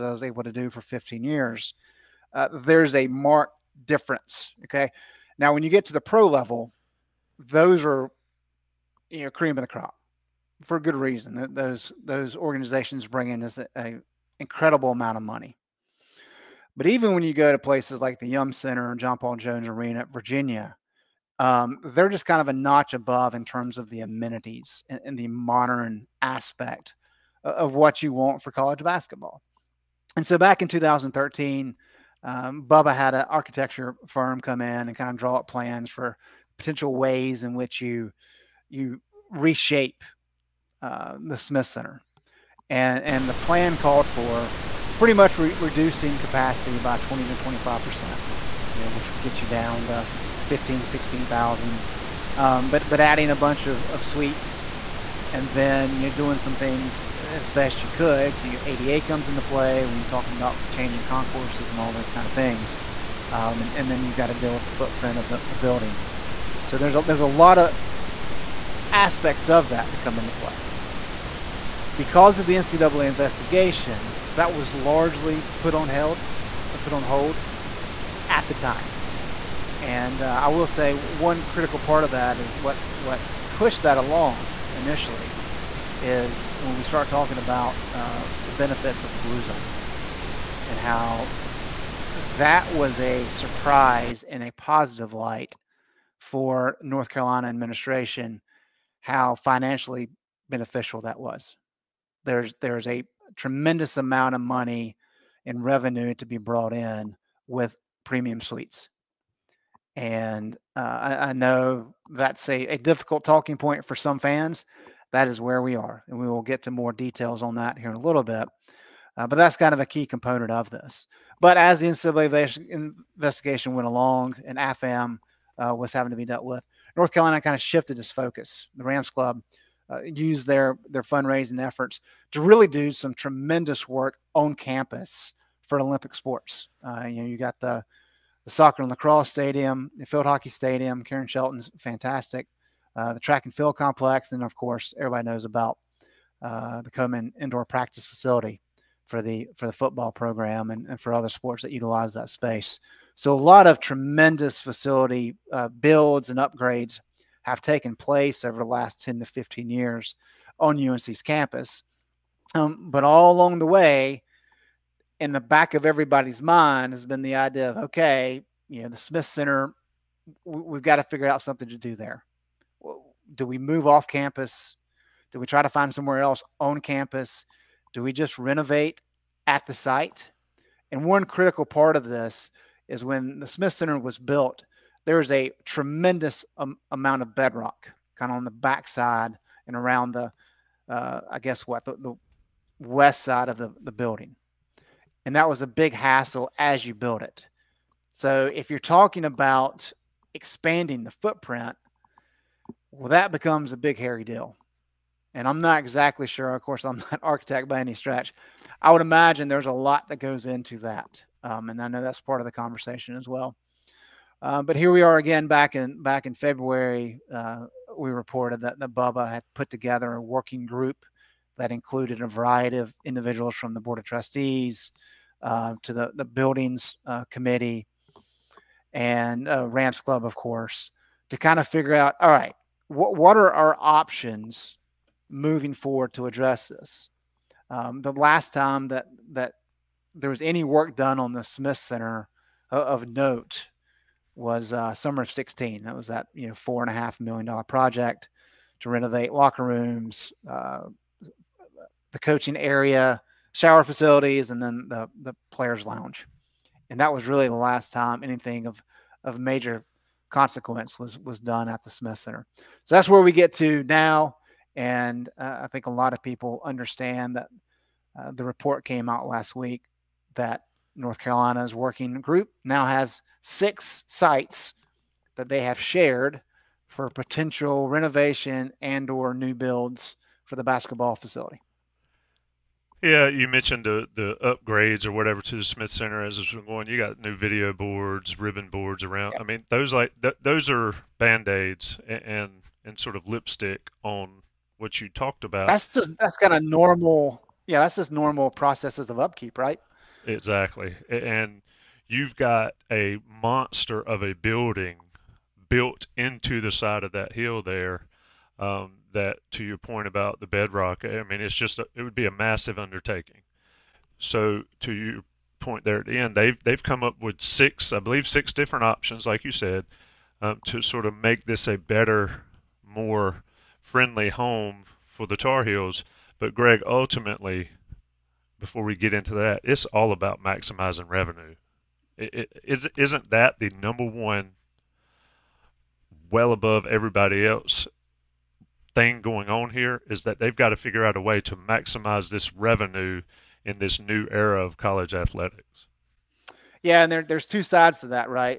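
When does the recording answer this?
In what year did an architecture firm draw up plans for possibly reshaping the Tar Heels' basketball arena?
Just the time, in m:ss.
0:30.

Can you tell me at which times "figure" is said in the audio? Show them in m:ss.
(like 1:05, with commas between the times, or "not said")
2:51, 3:51, 5:40.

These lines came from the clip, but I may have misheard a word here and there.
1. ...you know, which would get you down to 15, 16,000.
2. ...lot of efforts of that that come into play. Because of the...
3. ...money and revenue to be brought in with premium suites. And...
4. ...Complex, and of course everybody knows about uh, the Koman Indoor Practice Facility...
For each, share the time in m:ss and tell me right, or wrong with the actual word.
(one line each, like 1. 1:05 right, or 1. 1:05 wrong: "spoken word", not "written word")
1. 0:48 right
2. 1:07 wrong: "aspects", not "efforts"
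3. 1:44 right
4. 2:23 right.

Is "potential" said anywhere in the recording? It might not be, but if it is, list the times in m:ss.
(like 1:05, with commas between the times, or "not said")
0:36, 4:37.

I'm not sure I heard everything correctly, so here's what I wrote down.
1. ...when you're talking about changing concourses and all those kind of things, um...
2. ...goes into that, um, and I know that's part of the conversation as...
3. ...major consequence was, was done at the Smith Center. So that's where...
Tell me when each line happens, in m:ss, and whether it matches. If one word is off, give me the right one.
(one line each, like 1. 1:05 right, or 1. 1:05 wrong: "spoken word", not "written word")
1. 0:59 right
2. 3:30 right
3. 4:19 right.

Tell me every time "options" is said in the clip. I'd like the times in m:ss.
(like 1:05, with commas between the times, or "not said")
3:53, 5:18.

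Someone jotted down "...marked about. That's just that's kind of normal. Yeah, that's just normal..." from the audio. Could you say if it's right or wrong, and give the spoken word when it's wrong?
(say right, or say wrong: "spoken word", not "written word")
wrong: "talked", not "marked".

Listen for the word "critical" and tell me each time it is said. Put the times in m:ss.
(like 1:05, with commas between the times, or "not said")
1:21, 3:01.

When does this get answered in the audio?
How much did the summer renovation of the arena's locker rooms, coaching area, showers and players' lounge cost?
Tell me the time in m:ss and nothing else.
4:06.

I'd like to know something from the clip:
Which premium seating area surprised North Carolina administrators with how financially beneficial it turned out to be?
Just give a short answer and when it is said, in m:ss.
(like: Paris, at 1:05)
the blue zone, at 1:29.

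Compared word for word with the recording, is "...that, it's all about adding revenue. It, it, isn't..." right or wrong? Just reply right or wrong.
wrong.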